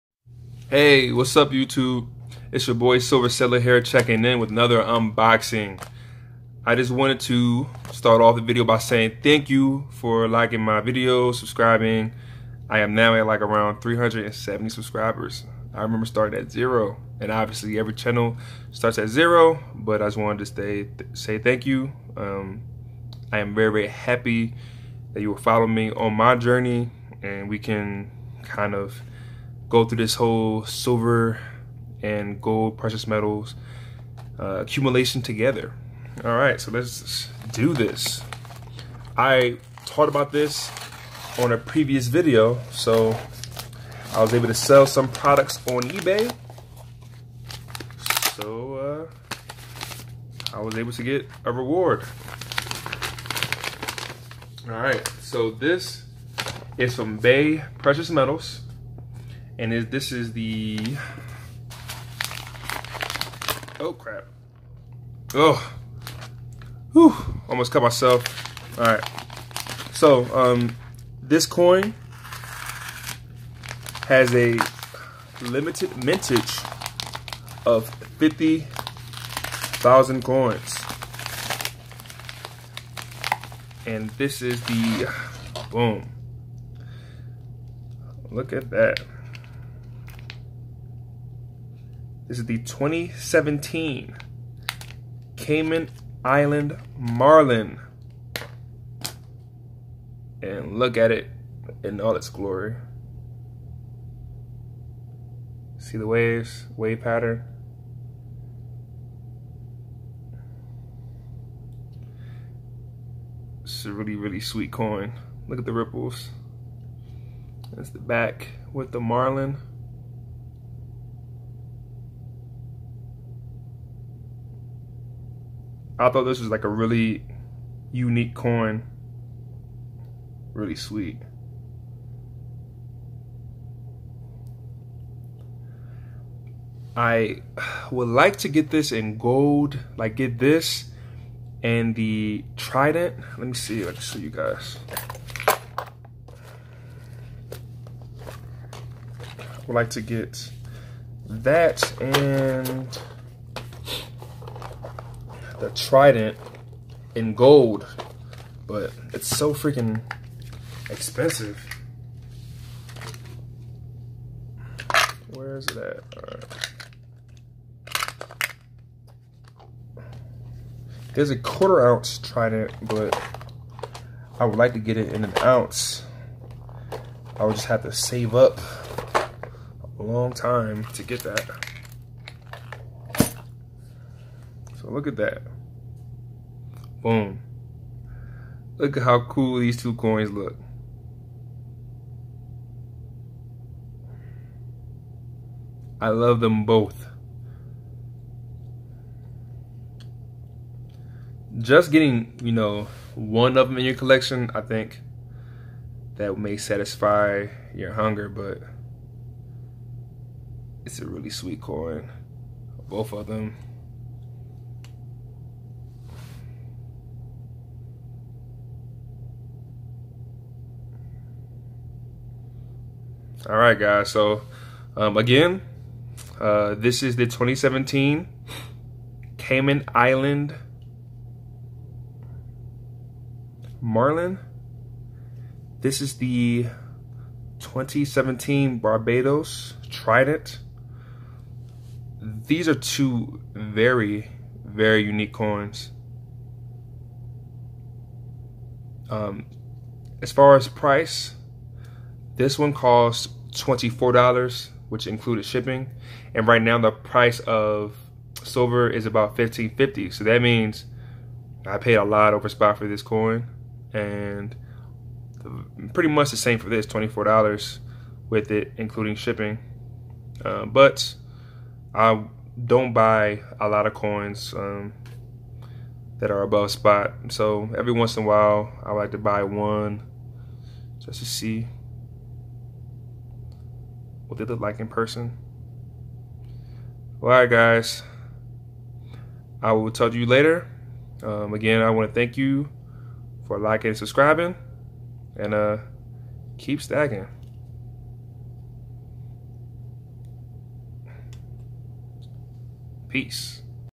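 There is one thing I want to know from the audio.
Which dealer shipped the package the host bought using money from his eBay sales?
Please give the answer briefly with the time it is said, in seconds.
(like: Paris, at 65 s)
Bay Precious Metals, at 57 s.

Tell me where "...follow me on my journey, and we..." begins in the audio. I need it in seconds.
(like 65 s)
25 s.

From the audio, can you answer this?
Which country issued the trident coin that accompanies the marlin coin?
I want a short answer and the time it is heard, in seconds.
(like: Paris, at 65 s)
Barbados, at 238 s.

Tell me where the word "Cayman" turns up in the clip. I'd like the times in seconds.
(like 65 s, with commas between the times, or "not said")
95 s, 229 s.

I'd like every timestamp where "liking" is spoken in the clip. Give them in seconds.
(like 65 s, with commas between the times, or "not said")
10 s, 293 s.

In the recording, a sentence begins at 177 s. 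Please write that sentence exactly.
I would just have to save up a long time to get that.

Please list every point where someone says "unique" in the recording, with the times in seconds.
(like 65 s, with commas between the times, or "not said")
127 s, 245 s.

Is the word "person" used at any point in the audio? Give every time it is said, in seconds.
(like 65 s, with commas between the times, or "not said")
284 s.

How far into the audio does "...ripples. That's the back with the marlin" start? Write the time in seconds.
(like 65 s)
115 s.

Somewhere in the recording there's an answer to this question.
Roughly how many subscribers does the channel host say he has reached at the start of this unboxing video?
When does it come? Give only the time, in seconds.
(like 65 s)
13 s.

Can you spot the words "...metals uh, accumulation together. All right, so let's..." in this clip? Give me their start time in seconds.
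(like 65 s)
33 s.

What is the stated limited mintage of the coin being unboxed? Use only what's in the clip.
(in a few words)
50,000.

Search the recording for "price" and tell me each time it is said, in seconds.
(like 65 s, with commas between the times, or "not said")
250 s, 256 s.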